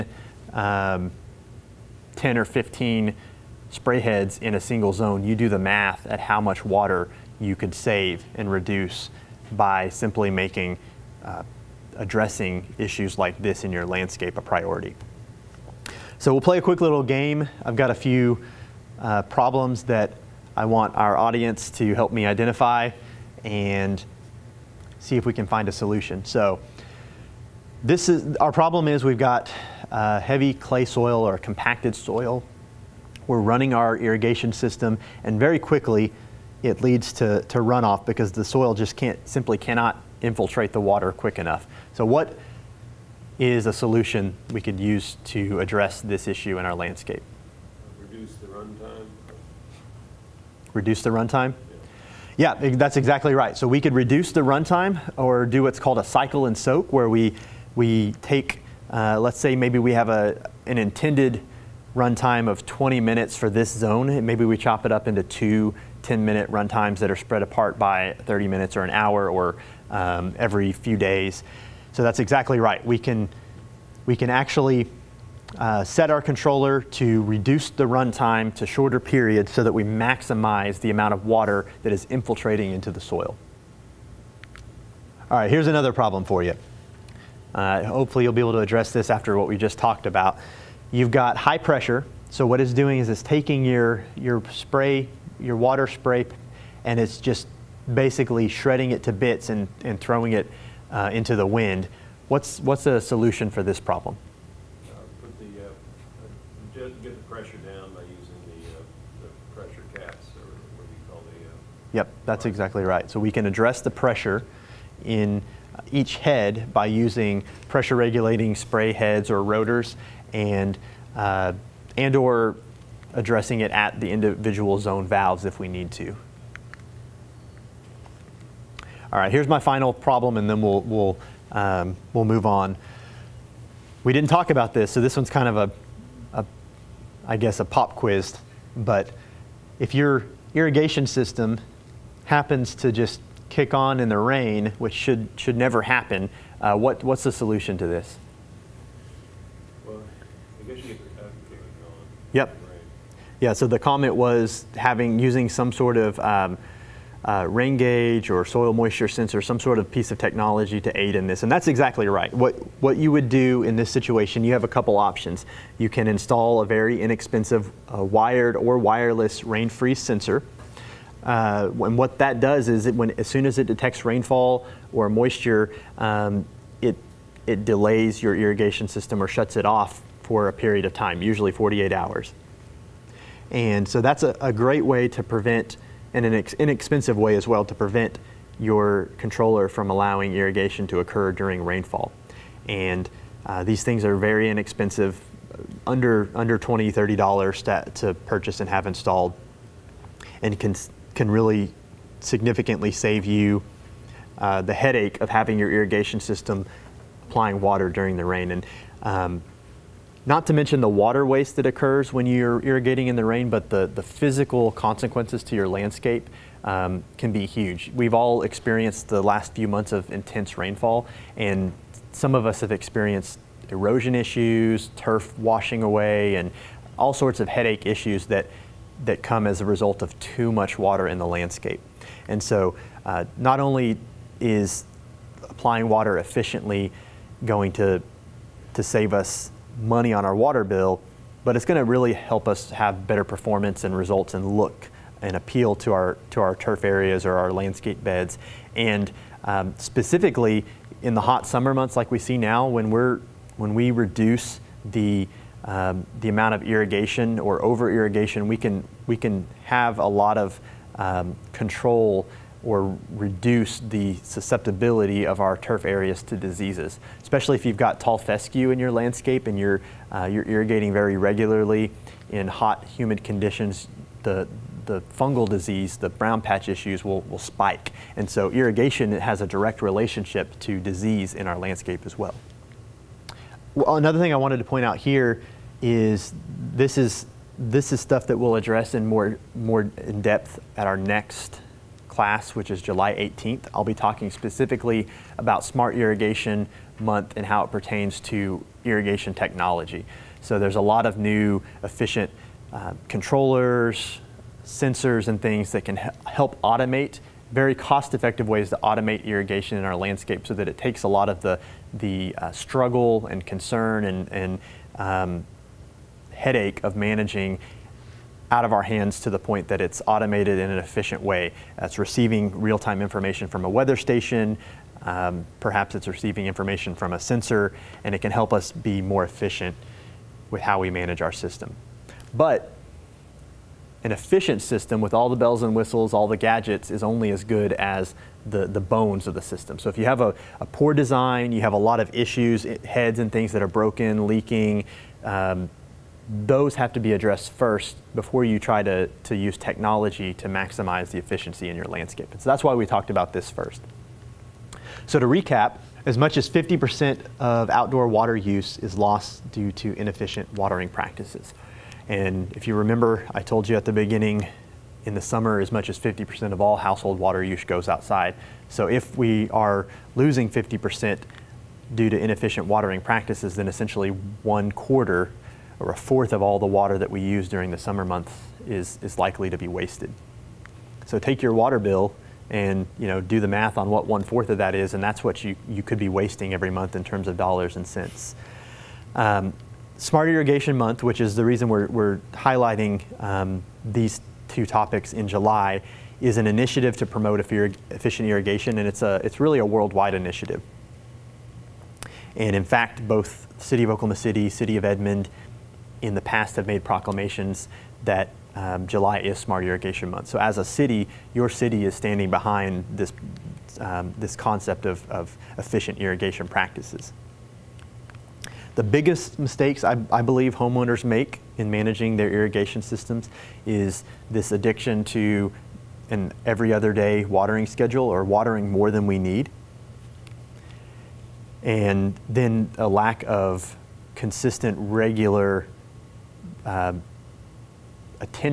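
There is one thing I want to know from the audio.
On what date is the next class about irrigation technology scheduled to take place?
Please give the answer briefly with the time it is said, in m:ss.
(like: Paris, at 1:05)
July 18, at 4:52.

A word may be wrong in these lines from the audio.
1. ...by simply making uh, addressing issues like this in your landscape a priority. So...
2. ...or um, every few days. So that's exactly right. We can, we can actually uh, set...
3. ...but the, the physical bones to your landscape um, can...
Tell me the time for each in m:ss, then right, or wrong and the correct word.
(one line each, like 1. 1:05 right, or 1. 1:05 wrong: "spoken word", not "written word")
1. 0:09 right
2. 1:09 right
3. 3:33 wrong: "consequences", not "bones".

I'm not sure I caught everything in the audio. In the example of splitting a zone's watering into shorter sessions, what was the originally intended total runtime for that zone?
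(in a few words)
20 minutes.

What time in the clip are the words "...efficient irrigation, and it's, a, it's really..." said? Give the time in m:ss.
6:37.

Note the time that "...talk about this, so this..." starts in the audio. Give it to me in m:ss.
2:14.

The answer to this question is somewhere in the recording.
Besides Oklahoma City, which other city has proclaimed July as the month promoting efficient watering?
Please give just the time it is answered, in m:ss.
6:44.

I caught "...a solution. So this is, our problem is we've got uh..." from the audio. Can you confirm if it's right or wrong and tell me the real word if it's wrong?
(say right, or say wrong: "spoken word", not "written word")
right.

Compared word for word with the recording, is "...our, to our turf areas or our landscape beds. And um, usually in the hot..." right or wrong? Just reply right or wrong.
wrong.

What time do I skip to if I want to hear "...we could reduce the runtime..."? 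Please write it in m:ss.
0:53.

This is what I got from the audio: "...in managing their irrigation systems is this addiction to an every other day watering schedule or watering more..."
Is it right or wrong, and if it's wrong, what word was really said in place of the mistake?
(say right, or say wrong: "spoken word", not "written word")
right.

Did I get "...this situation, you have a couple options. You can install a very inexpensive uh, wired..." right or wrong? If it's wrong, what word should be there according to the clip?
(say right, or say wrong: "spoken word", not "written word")
right.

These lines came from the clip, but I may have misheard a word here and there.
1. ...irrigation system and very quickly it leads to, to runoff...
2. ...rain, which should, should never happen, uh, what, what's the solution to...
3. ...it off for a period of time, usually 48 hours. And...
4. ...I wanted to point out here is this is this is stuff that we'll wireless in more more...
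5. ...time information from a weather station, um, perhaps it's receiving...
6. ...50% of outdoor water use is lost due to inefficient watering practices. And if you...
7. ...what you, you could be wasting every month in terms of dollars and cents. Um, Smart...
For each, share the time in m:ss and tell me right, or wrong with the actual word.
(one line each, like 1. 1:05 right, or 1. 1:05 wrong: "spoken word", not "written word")
1. 0:33 right
2. 2:24 right
3. 2:59 right
4. 4:44 wrong: "address", not "wireless"
5. 5:22 right
6. 5:56 right
7. 6:25 right.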